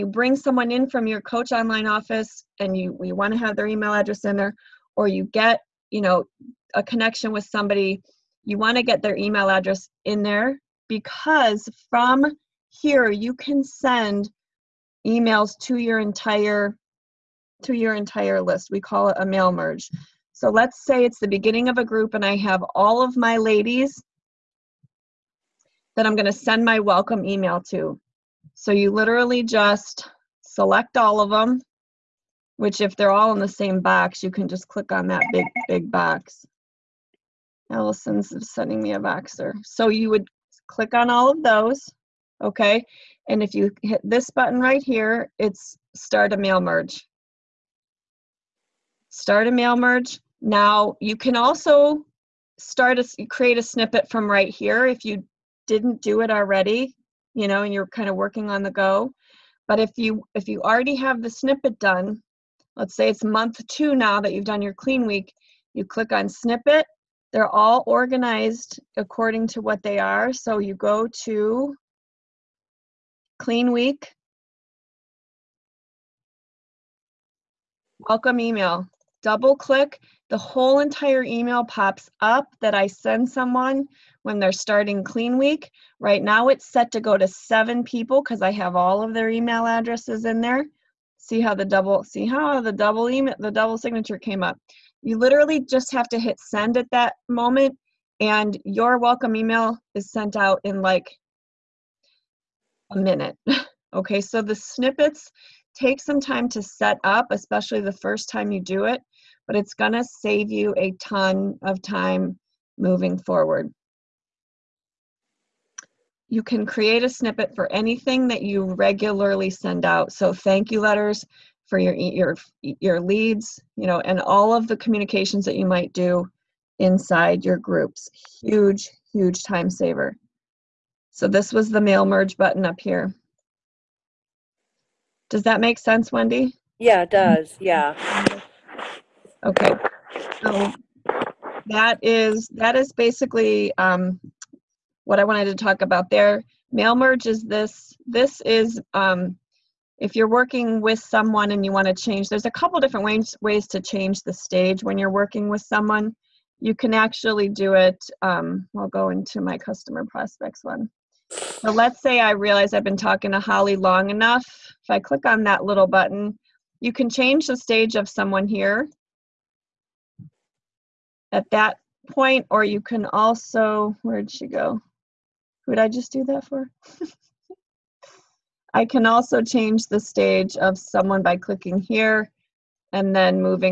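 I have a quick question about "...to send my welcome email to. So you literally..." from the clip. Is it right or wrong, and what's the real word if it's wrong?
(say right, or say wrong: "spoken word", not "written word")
right.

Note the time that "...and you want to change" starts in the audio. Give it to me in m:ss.
2:31.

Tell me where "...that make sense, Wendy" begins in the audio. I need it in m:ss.
2:15.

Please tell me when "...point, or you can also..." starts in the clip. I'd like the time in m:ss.
2:52.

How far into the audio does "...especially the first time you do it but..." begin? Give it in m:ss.
1:47.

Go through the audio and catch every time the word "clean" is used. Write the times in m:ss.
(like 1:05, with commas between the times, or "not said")
1:04, 1:13, 1:25.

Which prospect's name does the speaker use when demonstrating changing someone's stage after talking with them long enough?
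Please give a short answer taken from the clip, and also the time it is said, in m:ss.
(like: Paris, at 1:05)
Holly, at 2:43.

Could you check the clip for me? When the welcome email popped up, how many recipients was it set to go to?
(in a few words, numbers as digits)
7.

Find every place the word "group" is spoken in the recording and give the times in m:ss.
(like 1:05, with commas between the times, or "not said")
0:21, 2:07.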